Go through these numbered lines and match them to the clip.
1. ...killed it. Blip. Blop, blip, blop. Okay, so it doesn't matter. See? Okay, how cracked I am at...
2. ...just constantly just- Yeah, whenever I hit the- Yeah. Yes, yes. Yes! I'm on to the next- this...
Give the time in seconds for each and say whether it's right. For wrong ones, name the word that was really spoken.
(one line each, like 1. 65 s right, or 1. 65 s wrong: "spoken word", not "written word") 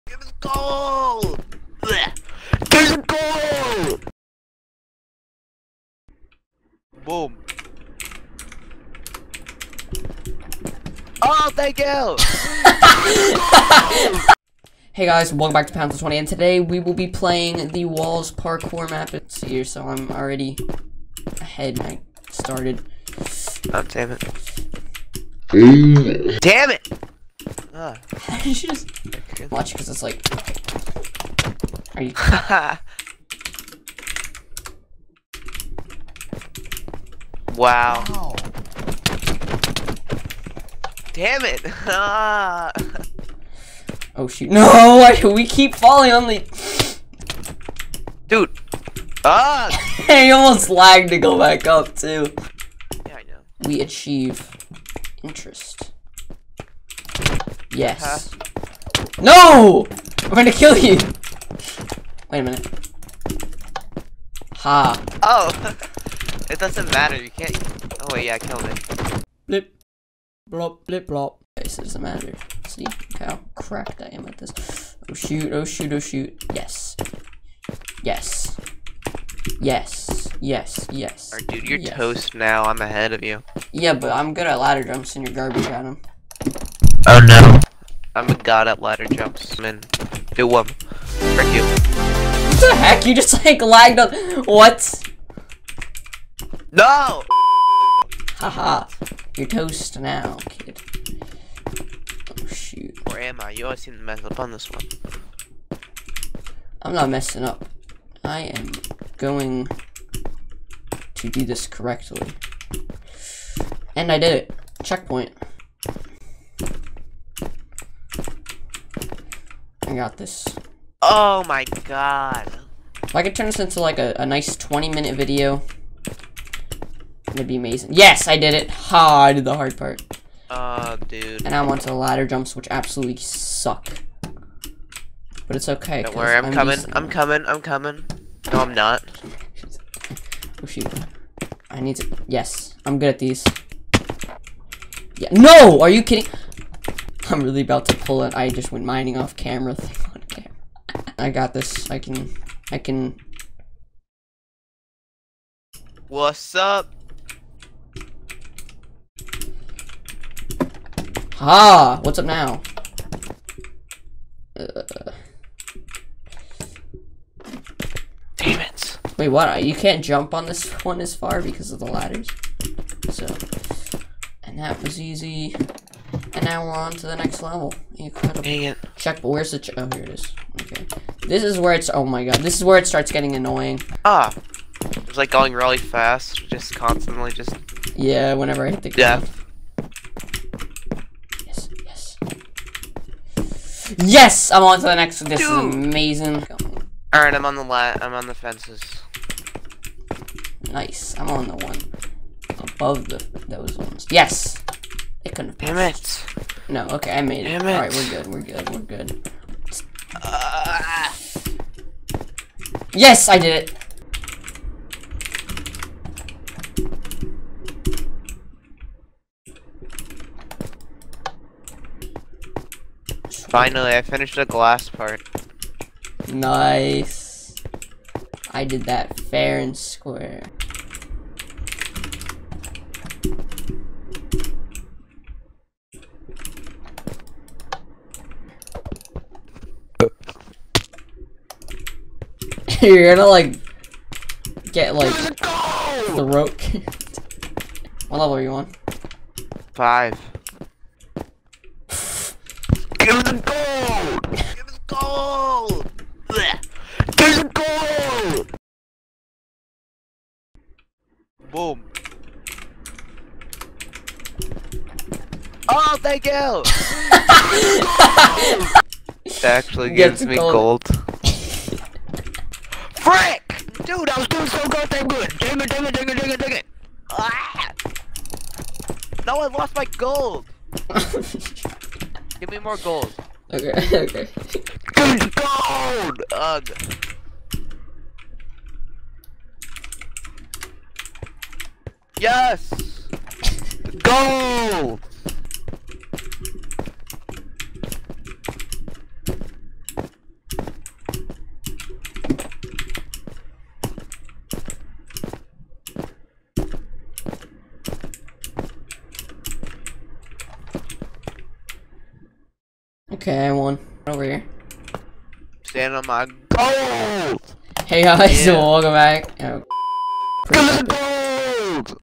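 1. 68 s right
2. 186 s right.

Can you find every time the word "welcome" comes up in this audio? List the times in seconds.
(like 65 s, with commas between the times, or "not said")
15 s, 318 s.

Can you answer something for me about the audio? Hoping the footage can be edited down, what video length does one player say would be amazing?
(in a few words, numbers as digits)
20 minutes.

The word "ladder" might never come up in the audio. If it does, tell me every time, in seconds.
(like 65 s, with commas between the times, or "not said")
84 s, 88 s, 131 s, 171 s.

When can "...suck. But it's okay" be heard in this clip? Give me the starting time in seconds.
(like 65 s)
133 s.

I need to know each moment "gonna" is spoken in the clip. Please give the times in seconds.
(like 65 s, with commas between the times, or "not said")
60 s, 243 s.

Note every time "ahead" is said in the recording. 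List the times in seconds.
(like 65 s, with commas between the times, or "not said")
21 s, 82 s.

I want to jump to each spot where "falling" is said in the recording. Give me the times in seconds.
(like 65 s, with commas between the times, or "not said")
45 s.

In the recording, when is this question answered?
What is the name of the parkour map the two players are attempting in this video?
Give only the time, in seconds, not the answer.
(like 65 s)
17 s.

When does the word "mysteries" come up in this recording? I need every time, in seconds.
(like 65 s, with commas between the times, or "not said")
not said.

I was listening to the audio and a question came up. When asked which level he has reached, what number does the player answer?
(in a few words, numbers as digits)
5.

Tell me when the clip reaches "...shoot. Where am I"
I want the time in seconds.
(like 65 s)
102 s.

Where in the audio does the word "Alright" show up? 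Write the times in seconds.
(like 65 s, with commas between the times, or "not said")
197 s, 207 s.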